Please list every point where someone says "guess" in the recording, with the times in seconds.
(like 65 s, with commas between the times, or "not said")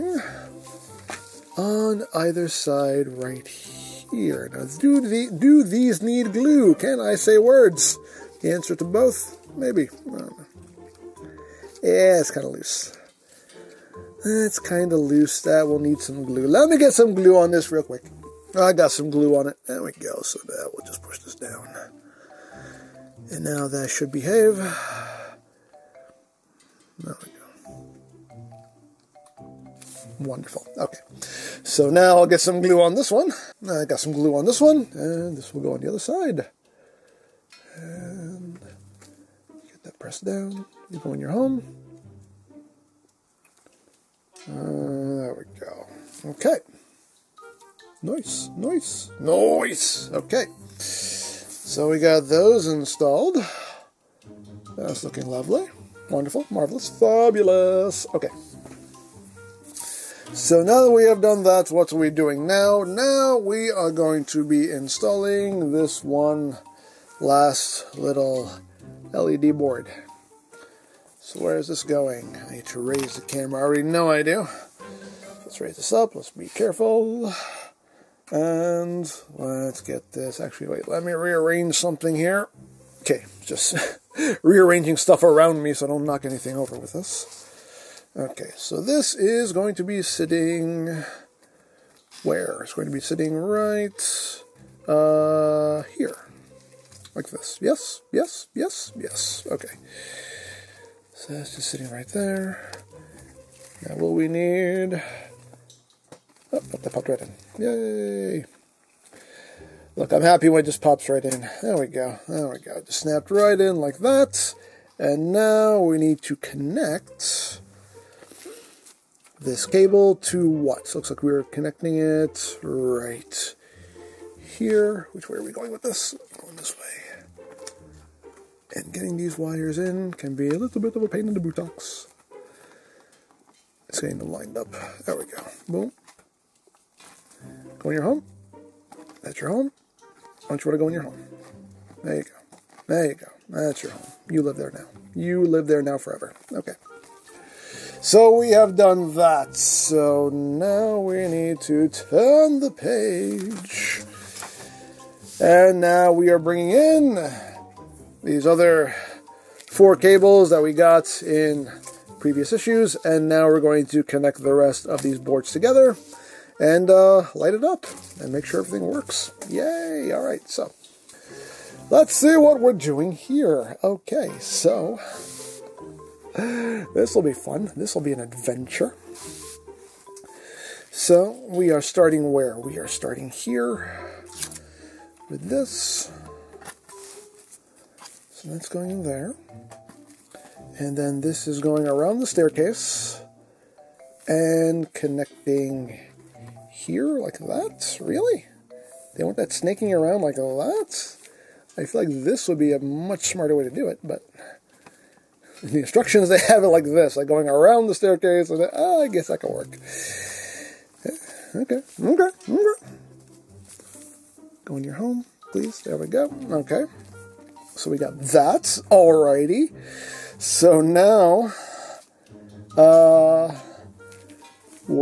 209 s.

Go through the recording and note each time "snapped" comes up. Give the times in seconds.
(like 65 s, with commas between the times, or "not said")
112 s.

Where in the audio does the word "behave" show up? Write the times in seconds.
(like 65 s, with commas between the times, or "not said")
24 s.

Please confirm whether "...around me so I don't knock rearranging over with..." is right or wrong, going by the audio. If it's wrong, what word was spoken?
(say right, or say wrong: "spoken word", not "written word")
wrong: "anything", not "rearranging".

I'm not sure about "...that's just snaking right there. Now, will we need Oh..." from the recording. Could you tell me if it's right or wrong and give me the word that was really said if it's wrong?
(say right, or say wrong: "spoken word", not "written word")
wrong: "sitting", not "snaking".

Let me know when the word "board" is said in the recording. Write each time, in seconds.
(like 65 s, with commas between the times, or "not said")
69 s, 165 s.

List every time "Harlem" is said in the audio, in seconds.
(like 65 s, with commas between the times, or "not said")
not said.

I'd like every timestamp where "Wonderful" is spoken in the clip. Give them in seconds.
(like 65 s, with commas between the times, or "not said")
30 s, 56 s.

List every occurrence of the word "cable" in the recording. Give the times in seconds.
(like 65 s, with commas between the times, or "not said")
119 s, 159 s.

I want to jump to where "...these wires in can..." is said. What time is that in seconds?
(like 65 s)
129 s.